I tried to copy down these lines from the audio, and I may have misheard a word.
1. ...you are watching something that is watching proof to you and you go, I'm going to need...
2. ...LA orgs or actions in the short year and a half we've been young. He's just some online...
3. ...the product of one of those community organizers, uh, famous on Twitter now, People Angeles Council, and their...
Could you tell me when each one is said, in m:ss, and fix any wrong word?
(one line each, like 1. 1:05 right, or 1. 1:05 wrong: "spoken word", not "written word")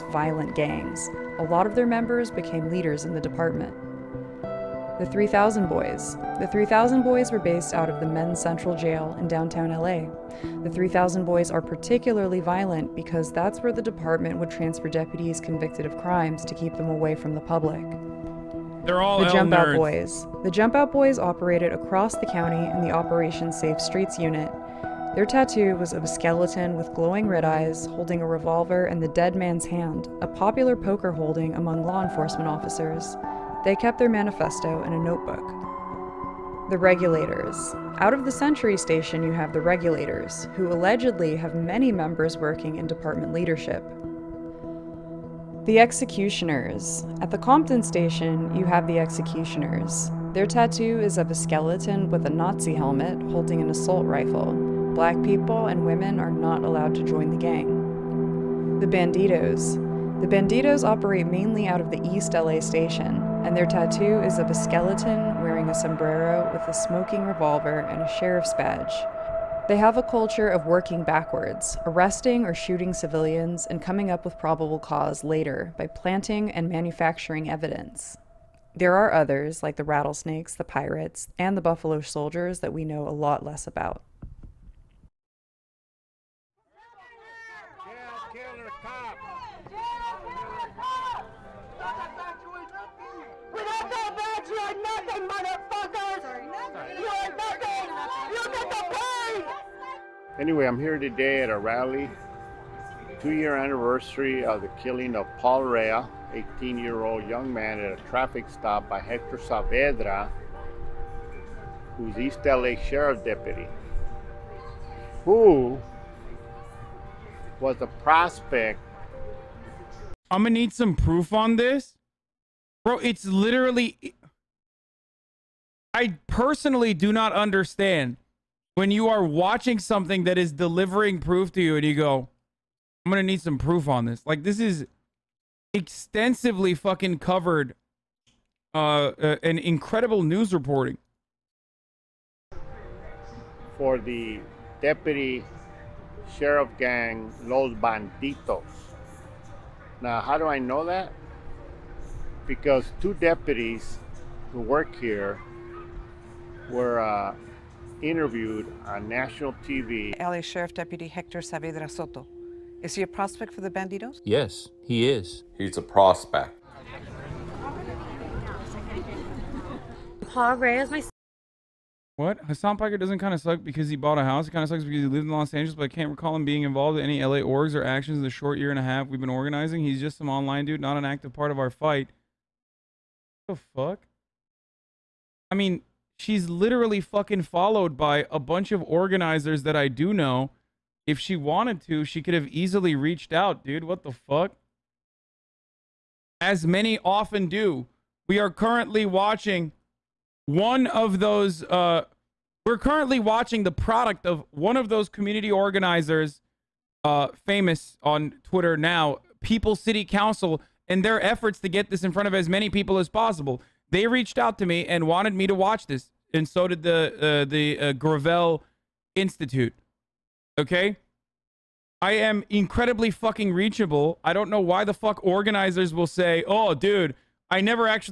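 1. 2:08 wrong: "delivering", not "watching"
2. 2:57 wrong: "organizing", not "young"
3. 3:23 wrong: "City", not "Angeles".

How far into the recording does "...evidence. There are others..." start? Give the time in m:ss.
1:17.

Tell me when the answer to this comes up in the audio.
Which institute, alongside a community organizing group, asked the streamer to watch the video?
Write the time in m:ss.
3:37.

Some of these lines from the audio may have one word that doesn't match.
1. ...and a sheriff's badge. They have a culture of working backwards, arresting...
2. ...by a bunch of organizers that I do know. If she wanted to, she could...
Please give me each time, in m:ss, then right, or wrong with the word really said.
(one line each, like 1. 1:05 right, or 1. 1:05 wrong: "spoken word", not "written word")
1. 1:07 right
2. 3:07 right.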